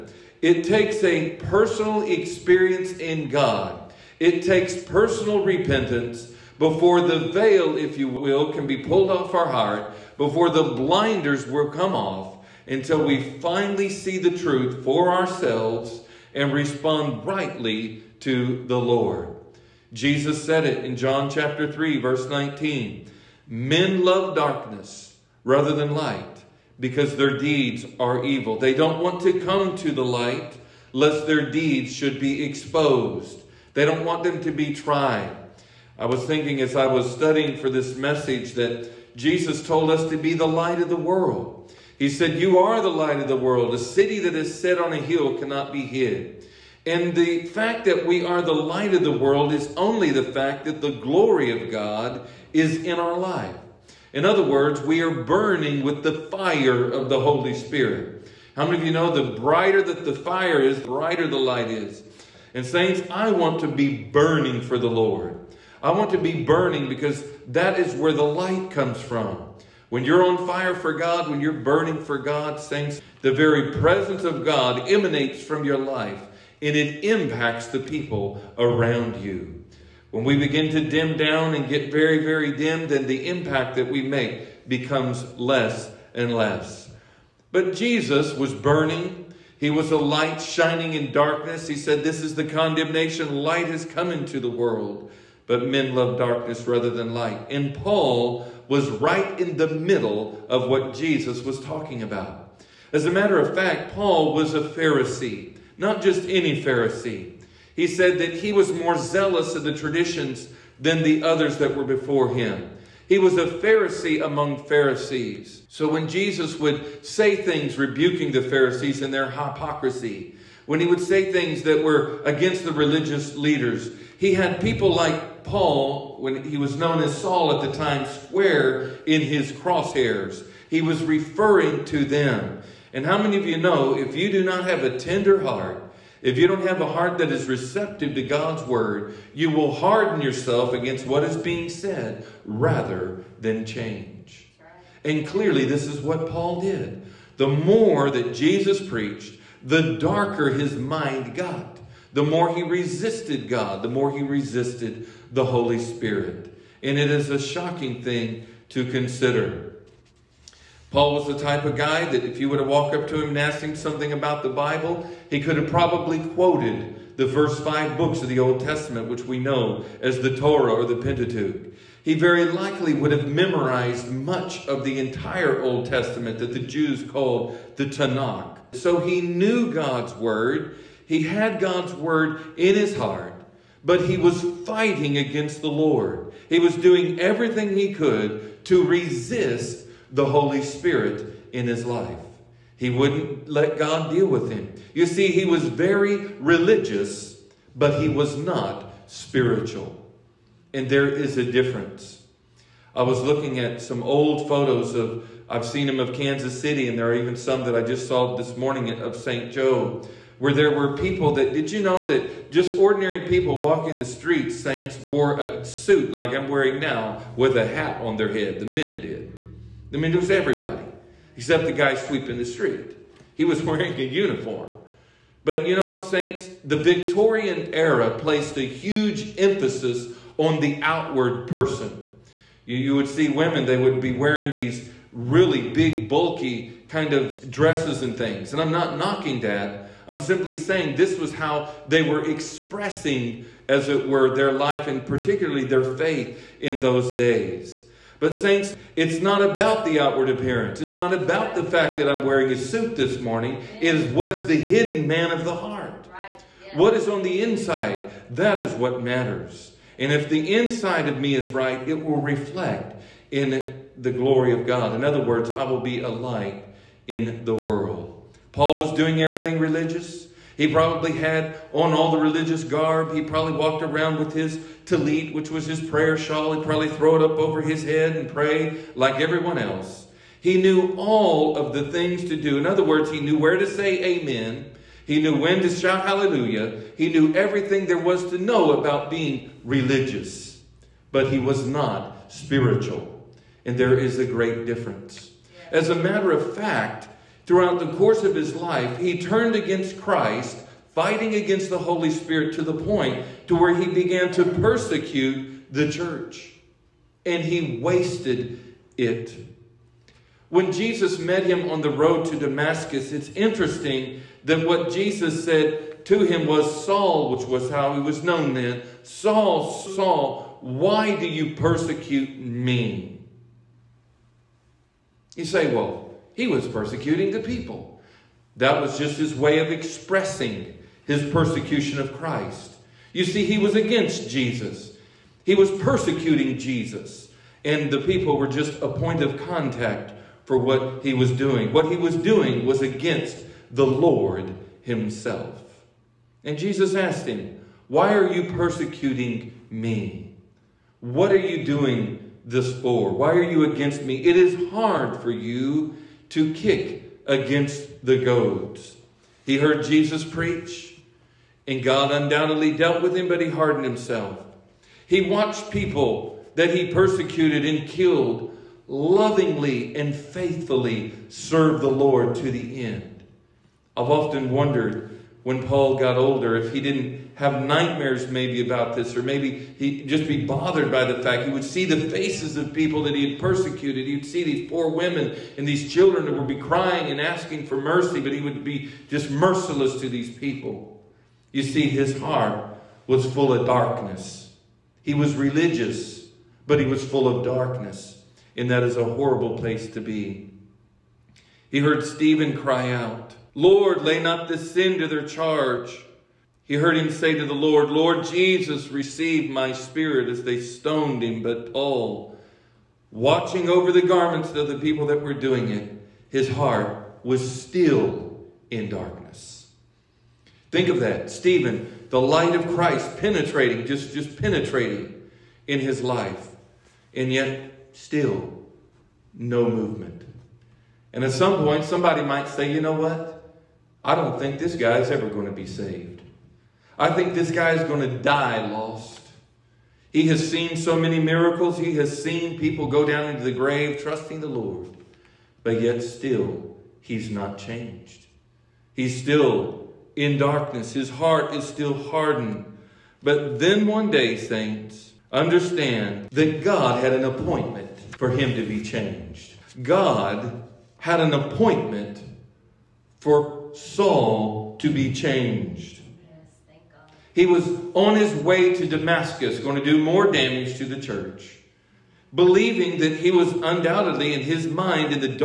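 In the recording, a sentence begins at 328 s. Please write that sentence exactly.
That was just his way of expressing his persecution of Christ.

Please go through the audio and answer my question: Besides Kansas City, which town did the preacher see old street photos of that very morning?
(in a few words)
St. Joe.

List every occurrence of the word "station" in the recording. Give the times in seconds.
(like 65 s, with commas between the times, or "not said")
not said.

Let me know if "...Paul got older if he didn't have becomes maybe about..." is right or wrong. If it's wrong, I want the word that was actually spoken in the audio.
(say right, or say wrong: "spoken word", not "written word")
wrong: "nightmares", not "becomes".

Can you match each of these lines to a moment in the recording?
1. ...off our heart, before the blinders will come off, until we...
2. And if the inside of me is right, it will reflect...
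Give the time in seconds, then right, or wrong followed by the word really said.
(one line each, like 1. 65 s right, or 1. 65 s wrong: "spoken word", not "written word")
1. 9 s right
2. 259 s right.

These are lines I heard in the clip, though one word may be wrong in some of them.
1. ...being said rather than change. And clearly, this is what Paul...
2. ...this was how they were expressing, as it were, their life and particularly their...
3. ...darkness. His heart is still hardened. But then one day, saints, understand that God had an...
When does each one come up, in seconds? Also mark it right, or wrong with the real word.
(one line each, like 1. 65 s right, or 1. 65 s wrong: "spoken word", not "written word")
1. 141 s right
2. 240 s right
3. 450 s right.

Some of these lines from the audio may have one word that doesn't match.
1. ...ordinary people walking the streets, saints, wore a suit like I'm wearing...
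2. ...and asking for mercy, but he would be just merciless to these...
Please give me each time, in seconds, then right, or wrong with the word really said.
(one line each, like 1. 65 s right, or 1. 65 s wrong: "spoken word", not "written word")
1. 212 s right
2. 387 s right.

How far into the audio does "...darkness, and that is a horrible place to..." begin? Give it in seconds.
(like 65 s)
397 s.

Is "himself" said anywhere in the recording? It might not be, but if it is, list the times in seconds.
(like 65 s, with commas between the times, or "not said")
344 s, 363 s.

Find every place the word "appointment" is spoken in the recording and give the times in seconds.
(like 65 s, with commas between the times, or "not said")
457 s, 461 s.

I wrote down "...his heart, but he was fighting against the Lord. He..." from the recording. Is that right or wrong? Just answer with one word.
right.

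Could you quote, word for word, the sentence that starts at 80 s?
When we begin to dim down and get very, very dim, then the impact that we make becomes less and less.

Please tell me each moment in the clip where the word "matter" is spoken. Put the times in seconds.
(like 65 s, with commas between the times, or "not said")
103 s, 259 s, 295 s.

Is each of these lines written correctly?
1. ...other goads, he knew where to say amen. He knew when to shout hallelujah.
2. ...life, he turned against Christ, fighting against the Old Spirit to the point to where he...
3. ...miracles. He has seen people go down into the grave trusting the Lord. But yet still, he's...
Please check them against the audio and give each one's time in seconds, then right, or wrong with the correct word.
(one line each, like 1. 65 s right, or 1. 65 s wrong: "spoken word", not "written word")
1. 282 s wrong: "words", not "goads"
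2. 298 s wrong: "Holy", not "Old"
3. 441 s right.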